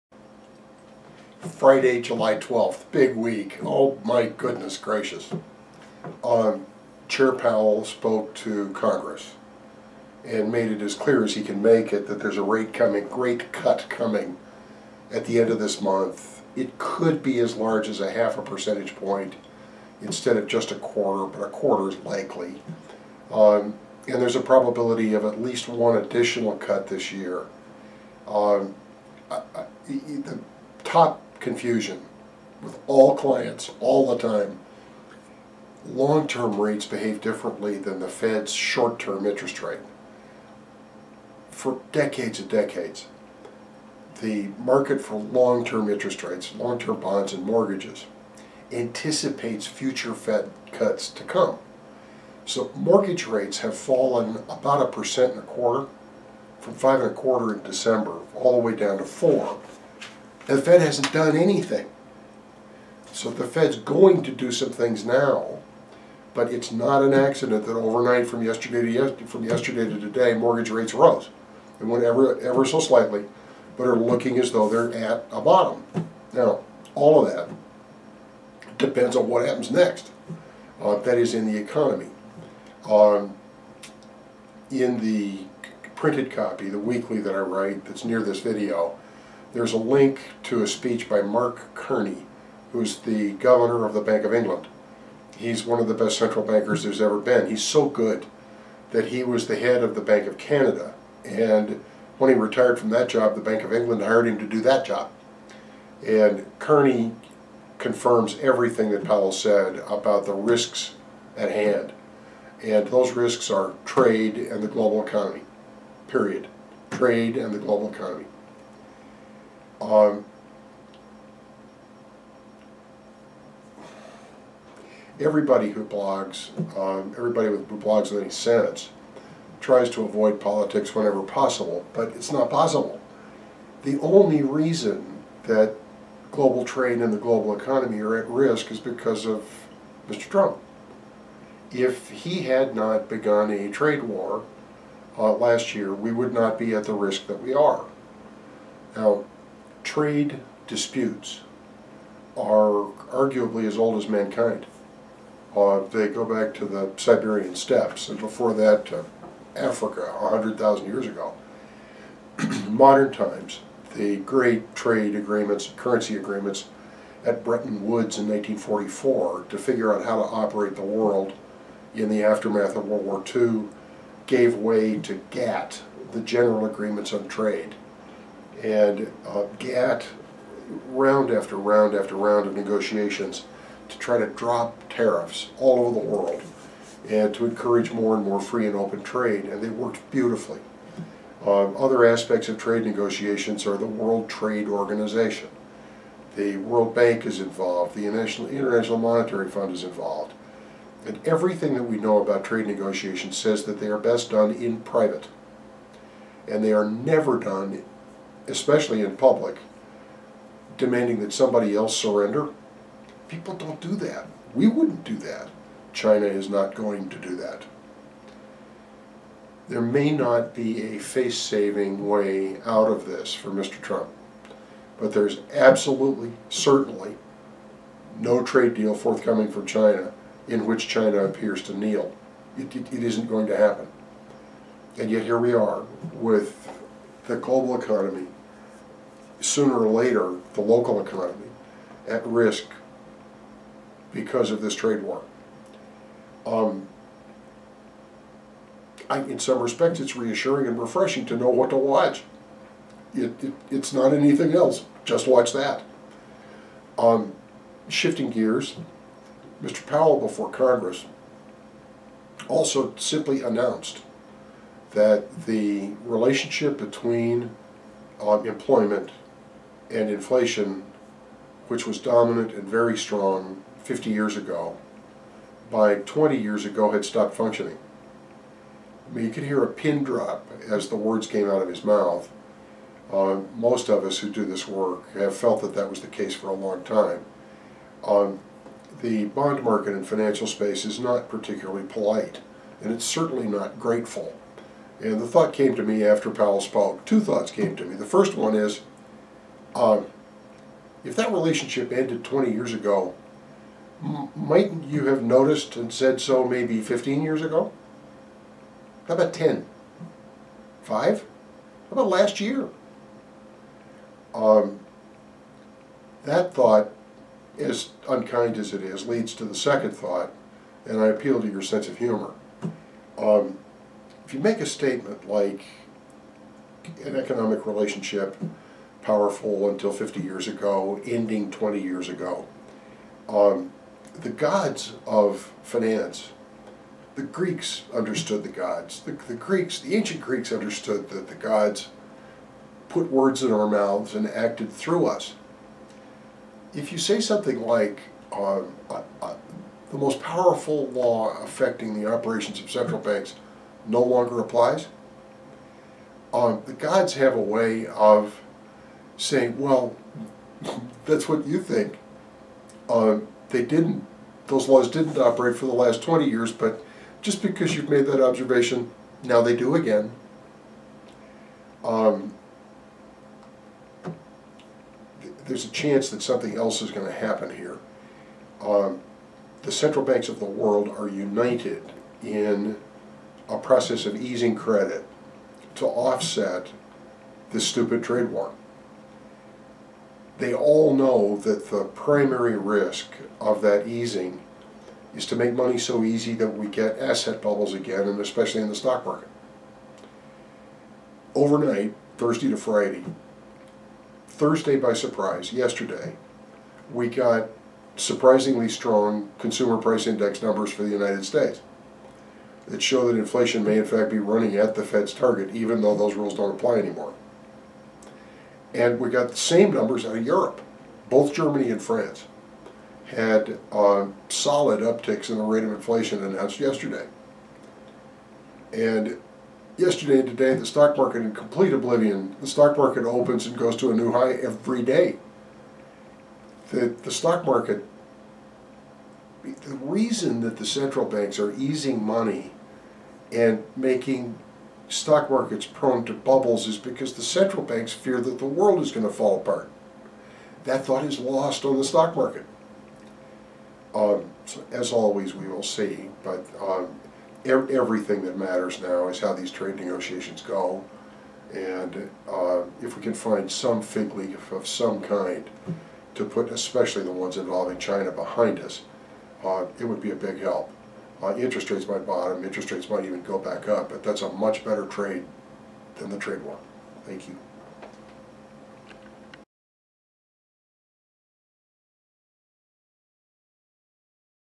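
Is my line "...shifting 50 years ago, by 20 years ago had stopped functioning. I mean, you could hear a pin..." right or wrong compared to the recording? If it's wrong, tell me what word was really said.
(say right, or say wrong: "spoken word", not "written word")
wrong: "strong", not "shifting".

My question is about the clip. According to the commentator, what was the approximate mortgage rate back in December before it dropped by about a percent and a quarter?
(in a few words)
5.25%.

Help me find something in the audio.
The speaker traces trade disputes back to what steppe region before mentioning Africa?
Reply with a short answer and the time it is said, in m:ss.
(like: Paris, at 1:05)
Siberian steppes, at 2:36.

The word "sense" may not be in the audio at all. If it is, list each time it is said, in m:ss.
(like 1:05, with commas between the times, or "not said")
2:08, 5:21.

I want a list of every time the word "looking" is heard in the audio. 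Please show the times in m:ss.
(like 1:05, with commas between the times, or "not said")
1:13.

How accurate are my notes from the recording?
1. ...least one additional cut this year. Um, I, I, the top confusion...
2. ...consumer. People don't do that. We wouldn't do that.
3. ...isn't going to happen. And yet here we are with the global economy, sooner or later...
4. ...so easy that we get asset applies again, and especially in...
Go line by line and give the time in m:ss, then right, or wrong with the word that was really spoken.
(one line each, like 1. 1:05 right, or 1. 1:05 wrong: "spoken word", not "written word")
1. 0:25 right
2. 3:31 wrong: "surrender", not "consumer"
3. 3:53 right
4. 6:35 wrong: "bubbles", not "applies".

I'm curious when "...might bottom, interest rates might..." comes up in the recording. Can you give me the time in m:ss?
7:51.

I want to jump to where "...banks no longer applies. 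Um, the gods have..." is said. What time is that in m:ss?
5:53.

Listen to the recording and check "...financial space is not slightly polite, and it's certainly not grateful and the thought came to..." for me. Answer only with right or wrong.
wrong.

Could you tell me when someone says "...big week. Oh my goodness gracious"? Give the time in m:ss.
0:02.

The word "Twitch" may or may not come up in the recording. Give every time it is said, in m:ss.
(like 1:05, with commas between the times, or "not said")
not said.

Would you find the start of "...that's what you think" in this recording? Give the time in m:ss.
6:01.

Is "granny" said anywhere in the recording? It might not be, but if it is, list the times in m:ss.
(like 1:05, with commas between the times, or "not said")
not said.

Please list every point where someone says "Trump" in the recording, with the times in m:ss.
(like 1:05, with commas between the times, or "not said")
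2:20, 3:43.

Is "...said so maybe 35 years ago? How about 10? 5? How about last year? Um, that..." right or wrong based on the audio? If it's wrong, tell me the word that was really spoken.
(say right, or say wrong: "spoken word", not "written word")
wrong: "15", not "35".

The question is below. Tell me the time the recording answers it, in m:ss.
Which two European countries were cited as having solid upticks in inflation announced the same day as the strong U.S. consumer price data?
7:01.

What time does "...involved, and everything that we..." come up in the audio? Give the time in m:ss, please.
3:19.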